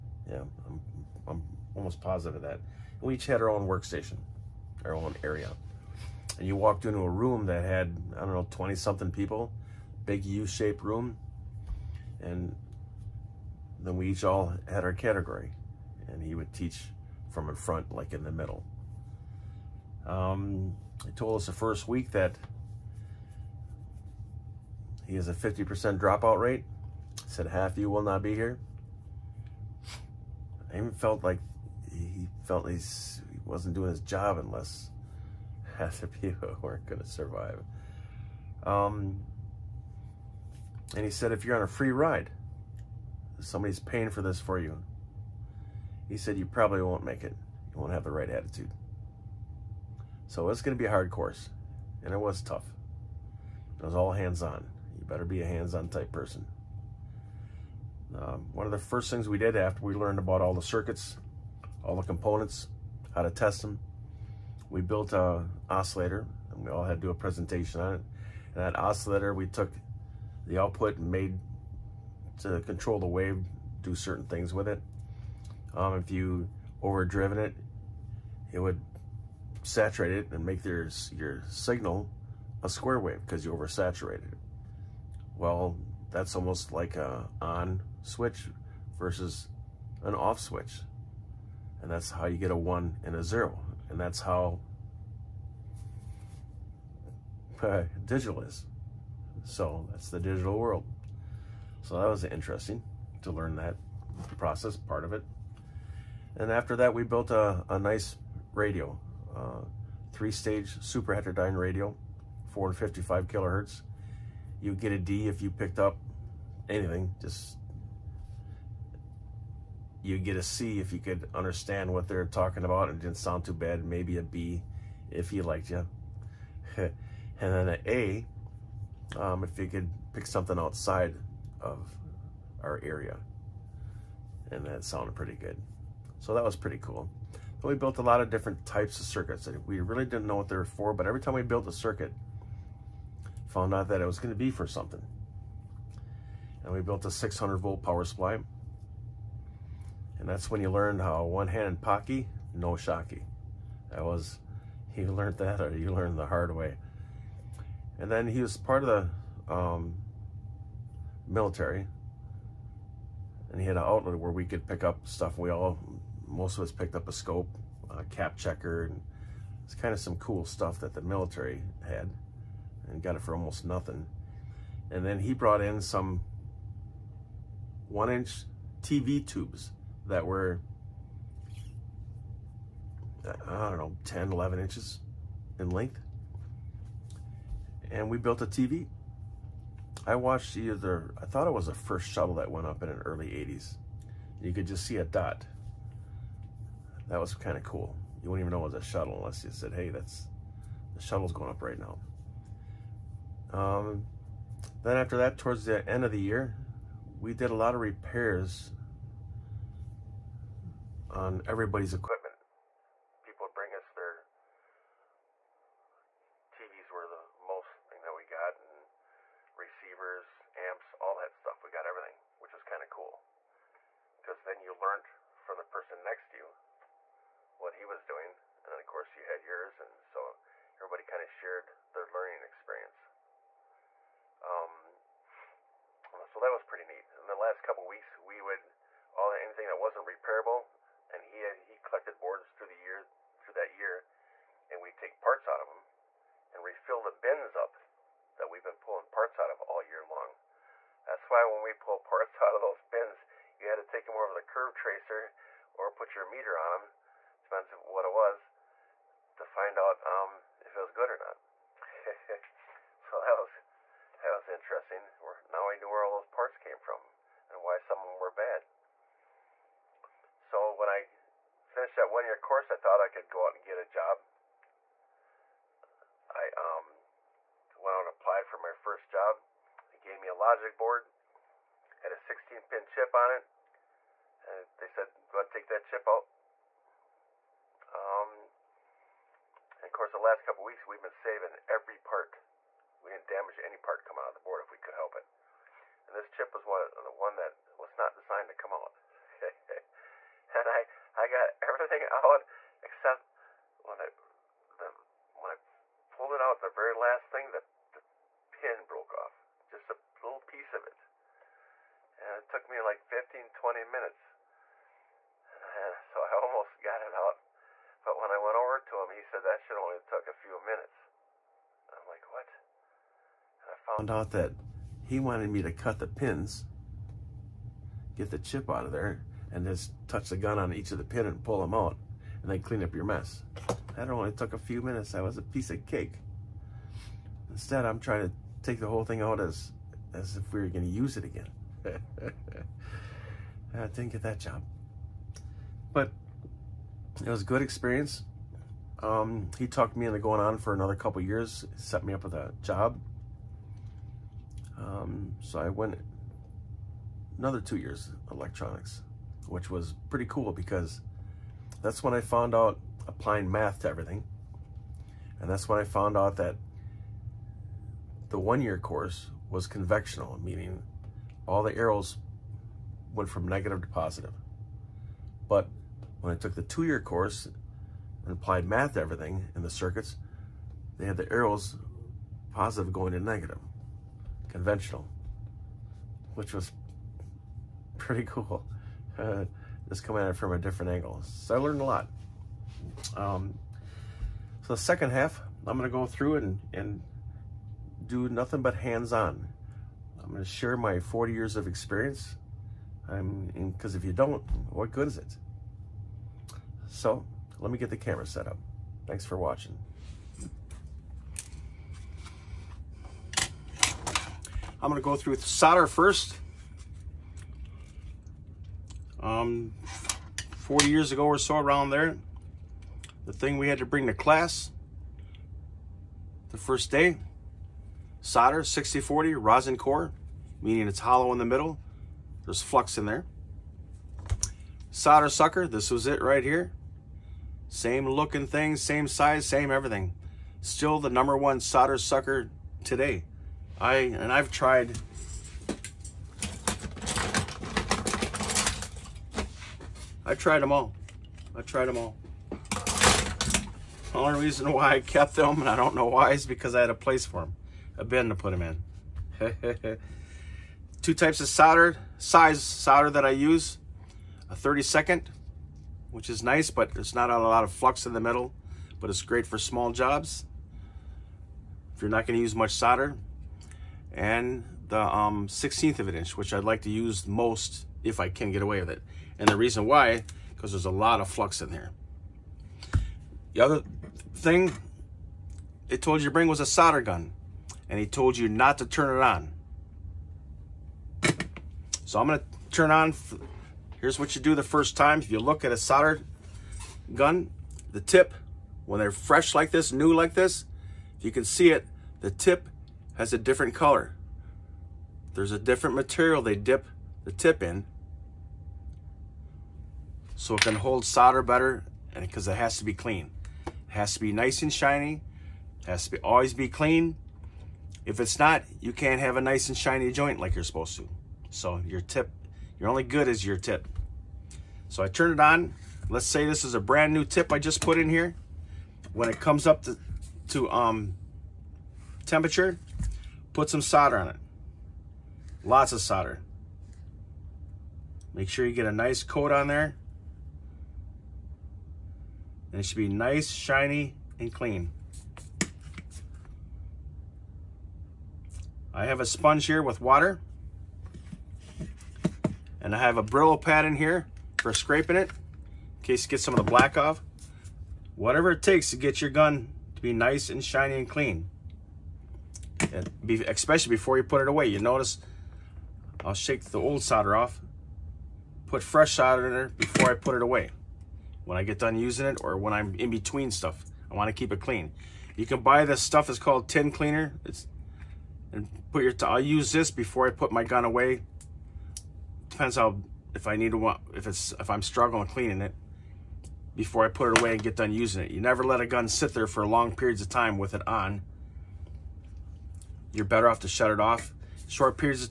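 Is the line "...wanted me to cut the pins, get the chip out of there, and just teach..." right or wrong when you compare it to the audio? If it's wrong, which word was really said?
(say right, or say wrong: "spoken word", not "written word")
wrong: "touch", not "teach".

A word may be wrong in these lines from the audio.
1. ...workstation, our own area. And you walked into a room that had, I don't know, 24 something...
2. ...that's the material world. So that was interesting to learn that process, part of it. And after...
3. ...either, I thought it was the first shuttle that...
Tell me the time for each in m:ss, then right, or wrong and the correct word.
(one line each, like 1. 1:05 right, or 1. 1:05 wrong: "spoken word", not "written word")
1. 0:03 wrong: "20", not "24"
2. 1:39 wrong: "digital", not "material"
3. 3:10 right.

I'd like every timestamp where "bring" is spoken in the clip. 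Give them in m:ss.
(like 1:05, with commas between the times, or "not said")
3:33, 7:03, 8:06.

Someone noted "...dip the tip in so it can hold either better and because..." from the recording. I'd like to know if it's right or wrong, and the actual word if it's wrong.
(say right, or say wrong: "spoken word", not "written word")
wrong: "solder", not "either".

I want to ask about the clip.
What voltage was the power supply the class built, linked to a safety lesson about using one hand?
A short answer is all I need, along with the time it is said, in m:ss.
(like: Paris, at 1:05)
600 volts, at 2:27.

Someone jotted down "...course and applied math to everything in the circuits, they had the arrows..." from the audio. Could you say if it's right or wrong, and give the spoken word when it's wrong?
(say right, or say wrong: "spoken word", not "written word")
right.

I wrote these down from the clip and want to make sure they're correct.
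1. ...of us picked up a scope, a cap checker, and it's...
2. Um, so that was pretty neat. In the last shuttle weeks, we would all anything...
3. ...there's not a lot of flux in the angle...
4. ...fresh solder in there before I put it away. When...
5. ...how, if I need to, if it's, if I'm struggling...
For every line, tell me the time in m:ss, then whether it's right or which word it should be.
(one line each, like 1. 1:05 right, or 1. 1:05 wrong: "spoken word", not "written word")
1. 2:46 right
2. 3:54 wrong: "couple", not "shuttle"
3. 7:46 wrong: "middle", not "angle"
4. 9:28 right
5. 9:42 right.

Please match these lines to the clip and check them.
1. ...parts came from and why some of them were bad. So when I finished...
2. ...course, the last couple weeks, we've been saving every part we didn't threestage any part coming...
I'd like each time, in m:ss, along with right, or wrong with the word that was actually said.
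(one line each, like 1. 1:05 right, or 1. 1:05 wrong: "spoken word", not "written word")
1. 4:26 right
2. 4:49 wrong: "damage", not "threestage".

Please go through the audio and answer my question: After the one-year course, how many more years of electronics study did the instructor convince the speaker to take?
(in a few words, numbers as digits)
2.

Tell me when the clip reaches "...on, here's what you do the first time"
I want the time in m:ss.
8:12.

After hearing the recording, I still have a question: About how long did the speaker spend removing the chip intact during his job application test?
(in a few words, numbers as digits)
15 to 20 minutes.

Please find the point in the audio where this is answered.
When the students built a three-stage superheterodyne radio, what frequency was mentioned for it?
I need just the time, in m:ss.
1:52.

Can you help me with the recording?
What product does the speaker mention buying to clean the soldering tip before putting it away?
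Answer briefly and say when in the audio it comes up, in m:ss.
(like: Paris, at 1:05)
Tin cleaner, at 9:36.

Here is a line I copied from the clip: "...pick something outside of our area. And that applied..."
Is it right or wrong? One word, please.
wrong.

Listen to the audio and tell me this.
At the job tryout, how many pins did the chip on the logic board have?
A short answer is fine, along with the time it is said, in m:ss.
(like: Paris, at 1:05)
16, at 4:42.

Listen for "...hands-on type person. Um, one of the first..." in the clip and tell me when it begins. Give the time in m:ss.
0:55.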